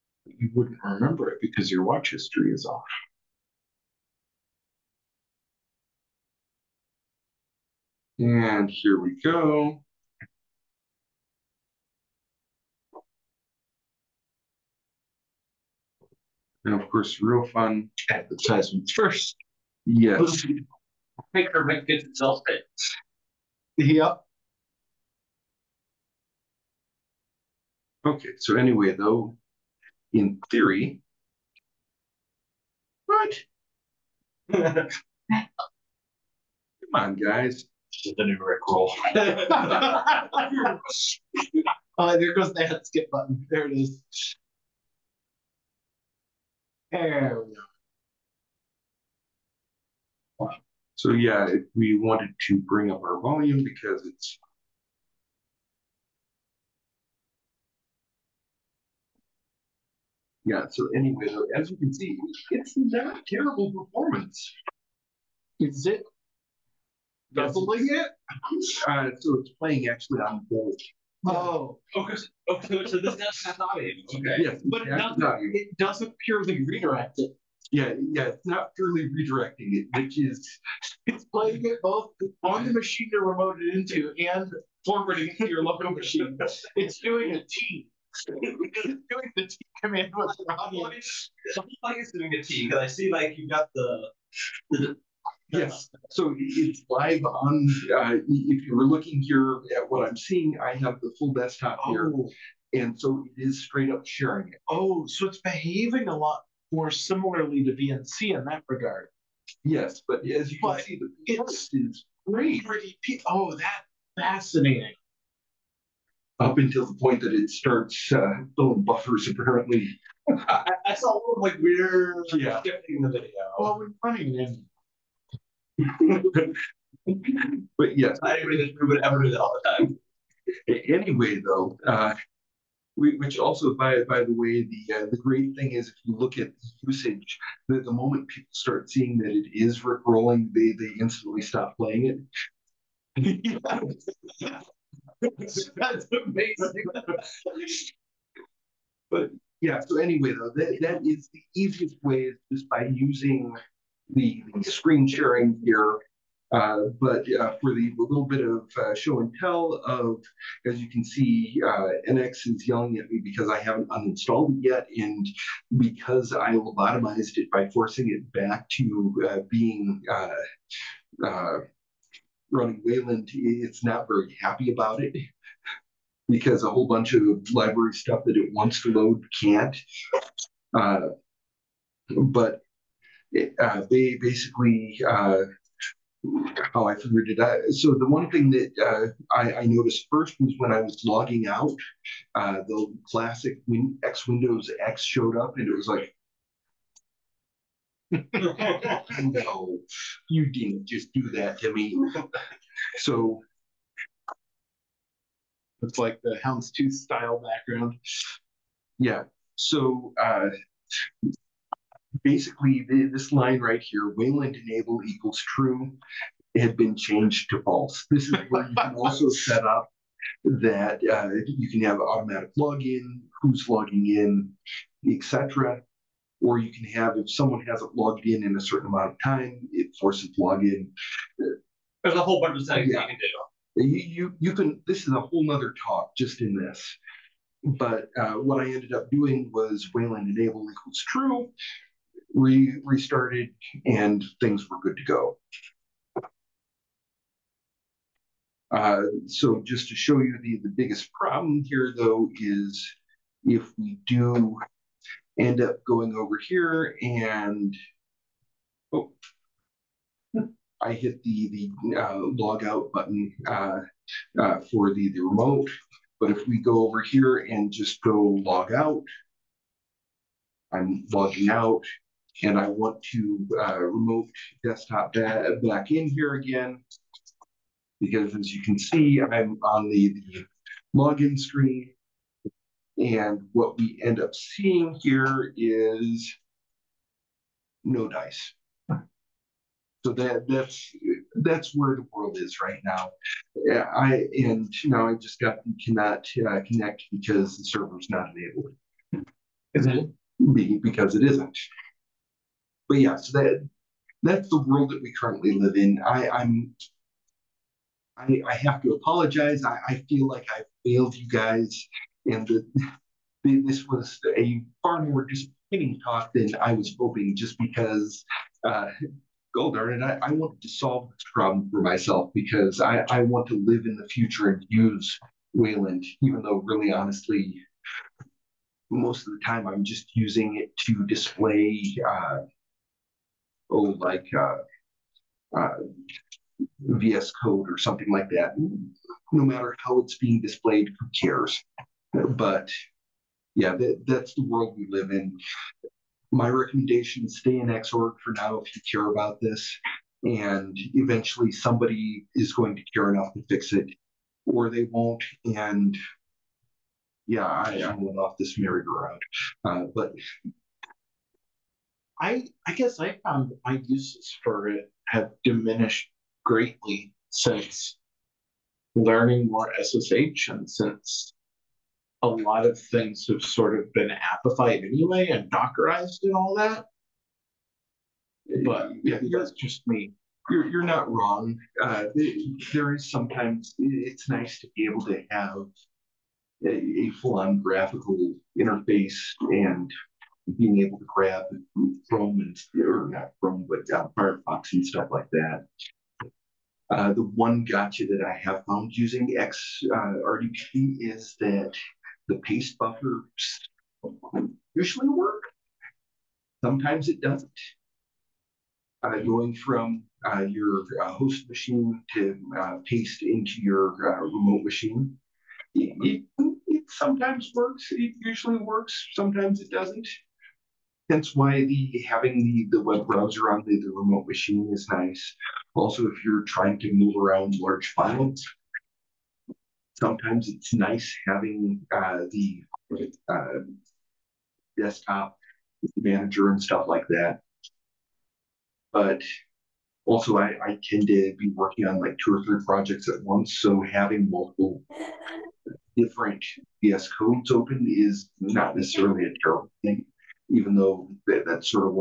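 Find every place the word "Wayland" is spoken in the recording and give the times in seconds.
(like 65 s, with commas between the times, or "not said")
172 s, 214 s, 239 s, 325 s.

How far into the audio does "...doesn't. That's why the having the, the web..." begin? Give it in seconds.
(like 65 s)
419 s.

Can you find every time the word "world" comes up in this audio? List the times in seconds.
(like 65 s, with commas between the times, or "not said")
292 s, 304 s, 344 s.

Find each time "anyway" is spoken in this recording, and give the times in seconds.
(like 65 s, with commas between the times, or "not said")
28 s, 60 s, 130 s, 149 s, 374 s.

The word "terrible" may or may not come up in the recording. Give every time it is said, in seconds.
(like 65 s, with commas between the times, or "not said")
63 s, 449 s.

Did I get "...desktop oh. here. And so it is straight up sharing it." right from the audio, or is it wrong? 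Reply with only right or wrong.
right.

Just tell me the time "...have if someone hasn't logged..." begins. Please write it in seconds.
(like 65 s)
226 s.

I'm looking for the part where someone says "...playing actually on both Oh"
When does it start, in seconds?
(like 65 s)
69 s.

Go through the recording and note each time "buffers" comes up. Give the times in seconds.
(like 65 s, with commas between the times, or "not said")
118 s, 402 s.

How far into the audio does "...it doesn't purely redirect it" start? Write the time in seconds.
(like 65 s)
75 s.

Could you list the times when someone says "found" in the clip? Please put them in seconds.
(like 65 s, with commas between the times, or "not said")
363 s, 398 s.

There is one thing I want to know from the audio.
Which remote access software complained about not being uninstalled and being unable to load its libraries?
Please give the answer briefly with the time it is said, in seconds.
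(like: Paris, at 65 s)
NX, at 162 s.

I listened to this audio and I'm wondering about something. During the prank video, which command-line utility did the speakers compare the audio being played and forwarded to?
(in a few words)
T command.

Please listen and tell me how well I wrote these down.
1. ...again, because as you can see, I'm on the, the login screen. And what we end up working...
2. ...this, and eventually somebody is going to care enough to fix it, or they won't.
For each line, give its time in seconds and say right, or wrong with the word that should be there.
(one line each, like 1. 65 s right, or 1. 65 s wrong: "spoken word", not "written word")
1. 276 s wrong: "seeing", not "working"
2. 349 s right.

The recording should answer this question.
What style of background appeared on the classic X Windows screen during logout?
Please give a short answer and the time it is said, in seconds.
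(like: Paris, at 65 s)
houndstooth, at 206 s.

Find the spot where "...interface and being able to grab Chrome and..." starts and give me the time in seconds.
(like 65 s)
388 s.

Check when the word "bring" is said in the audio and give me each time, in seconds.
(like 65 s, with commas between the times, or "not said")
52 s.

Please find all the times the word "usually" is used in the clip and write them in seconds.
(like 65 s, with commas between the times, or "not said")
404 s, 418 s.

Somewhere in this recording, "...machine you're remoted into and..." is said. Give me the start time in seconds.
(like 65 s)
82 s.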